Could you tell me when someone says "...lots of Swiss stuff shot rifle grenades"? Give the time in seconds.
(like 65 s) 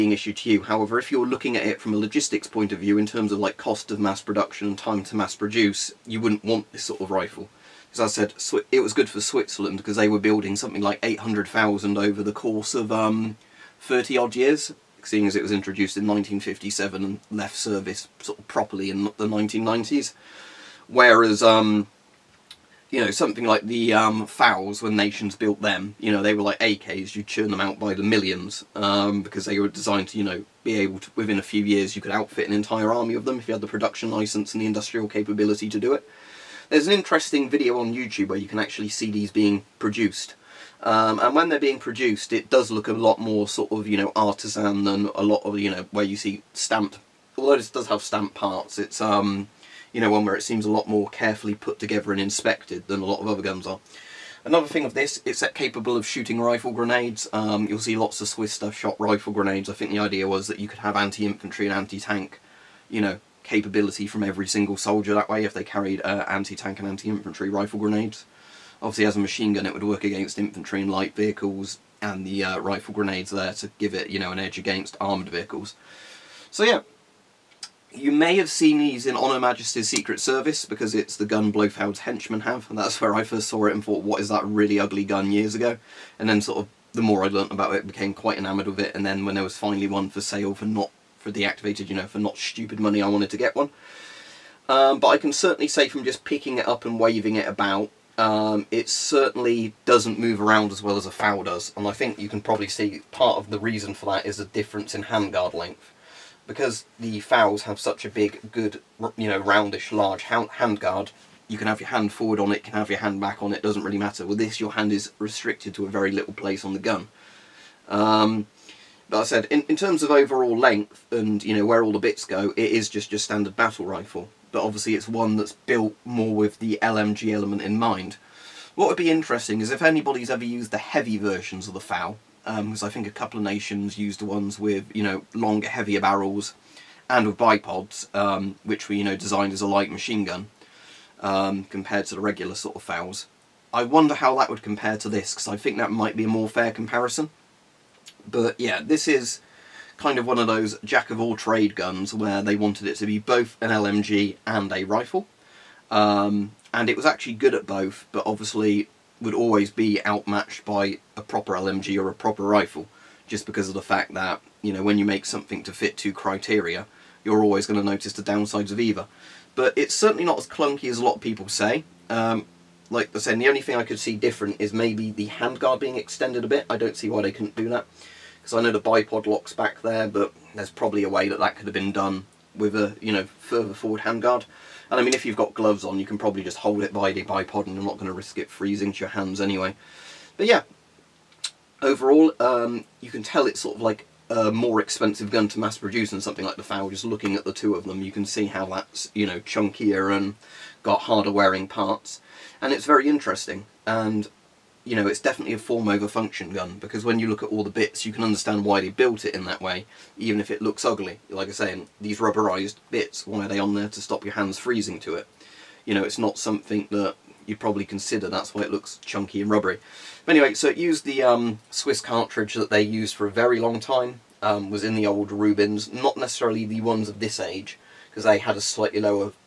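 57 s.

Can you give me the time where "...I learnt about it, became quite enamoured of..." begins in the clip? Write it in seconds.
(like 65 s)
87 s.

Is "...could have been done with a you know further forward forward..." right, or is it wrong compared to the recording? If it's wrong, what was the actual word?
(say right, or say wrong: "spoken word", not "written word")
wrong: "handguard", not "forward".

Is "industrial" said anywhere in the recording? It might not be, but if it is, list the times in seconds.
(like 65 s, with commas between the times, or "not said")
34 s.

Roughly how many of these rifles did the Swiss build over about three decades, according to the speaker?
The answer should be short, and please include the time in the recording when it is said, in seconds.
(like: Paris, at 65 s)
800,000, at 11 s.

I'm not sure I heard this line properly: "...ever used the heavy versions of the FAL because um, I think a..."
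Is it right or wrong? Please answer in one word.
right.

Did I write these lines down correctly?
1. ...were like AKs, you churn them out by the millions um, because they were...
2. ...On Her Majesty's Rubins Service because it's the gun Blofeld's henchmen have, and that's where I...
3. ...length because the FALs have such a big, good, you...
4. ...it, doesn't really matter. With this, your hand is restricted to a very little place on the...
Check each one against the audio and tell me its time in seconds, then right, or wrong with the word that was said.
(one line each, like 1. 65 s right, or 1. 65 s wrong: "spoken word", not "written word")
1. 26 s right
2. 79 s wrong: "Secret", not "Rubins"
3. 105 s right
4. 113 s right.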